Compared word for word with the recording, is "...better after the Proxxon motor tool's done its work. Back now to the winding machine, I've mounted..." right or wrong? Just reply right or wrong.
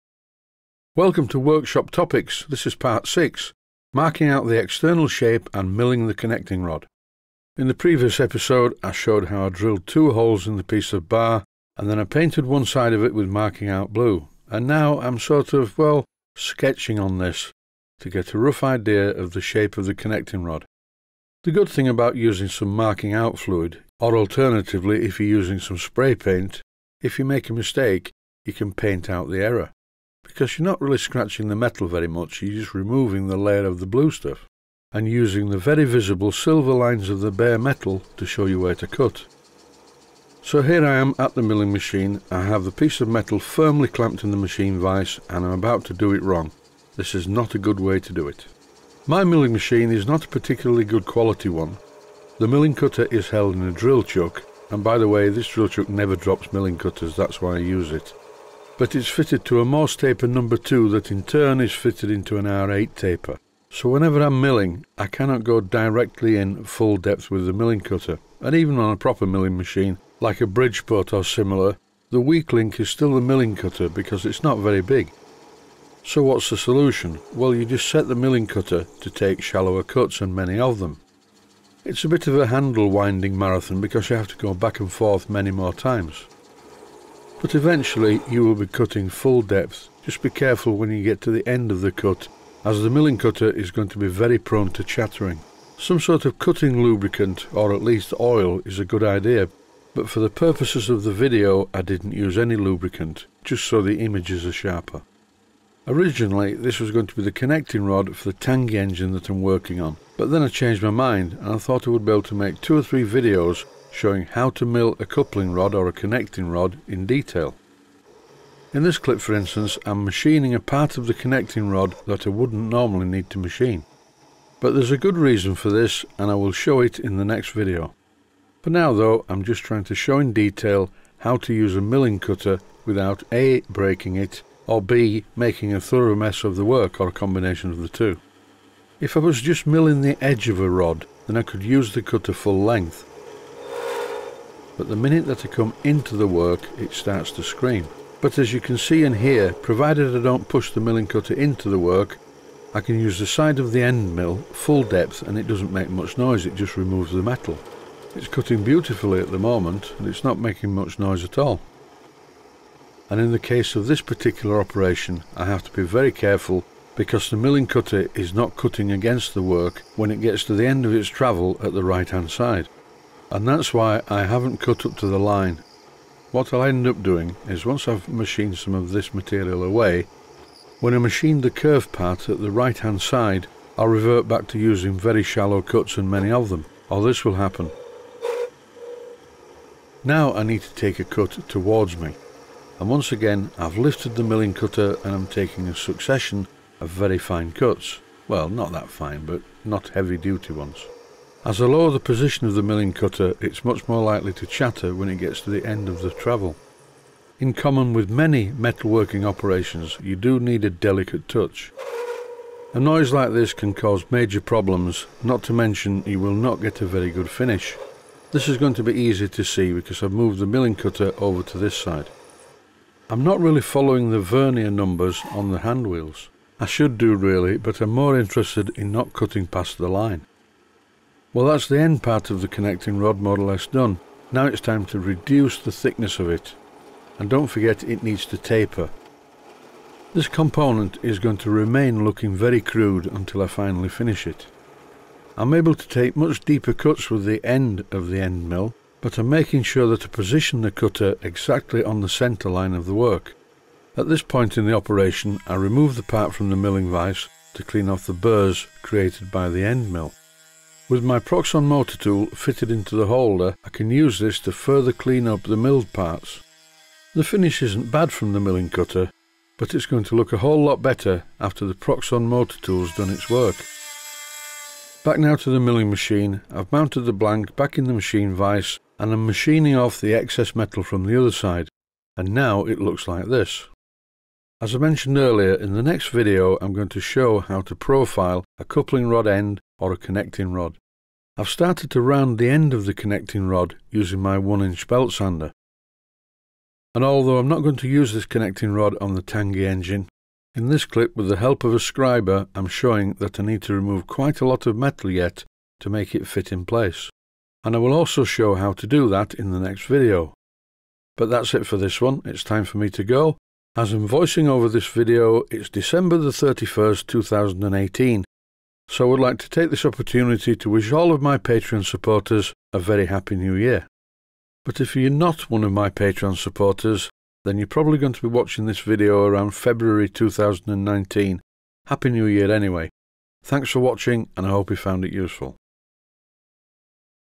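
wrong.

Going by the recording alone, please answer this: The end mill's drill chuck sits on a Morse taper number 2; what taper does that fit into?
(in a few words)
R8.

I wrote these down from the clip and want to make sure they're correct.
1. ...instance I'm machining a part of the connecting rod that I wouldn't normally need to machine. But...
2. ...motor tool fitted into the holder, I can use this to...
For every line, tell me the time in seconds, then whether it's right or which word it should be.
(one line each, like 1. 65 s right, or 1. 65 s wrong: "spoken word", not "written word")
1. 119 s right
2. 261 s right.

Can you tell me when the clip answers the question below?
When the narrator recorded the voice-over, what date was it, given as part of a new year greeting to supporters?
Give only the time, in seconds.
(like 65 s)
315 s.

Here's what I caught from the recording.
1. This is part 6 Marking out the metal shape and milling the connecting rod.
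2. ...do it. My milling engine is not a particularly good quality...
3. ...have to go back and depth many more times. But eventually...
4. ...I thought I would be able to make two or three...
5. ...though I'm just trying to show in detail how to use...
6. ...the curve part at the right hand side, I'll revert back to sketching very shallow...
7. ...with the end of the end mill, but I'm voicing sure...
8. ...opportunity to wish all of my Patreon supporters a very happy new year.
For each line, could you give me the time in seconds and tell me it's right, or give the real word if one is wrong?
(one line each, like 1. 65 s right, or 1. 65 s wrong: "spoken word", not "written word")
1. 2 s wrong: "external", not "metal"
2. 48 s wrong: "machine", not "engine"
3. 84 s wrong: "forth", not "depth"
4. 111 s right
5. 128 s right
6. 181 s wrong: "using", not "sketching"
7. 247 s wrong: "making", not "voicing"
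8. 319 s right.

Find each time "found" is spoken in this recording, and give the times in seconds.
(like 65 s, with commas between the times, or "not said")
334 s.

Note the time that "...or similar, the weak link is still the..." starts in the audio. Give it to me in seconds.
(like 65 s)
71 s.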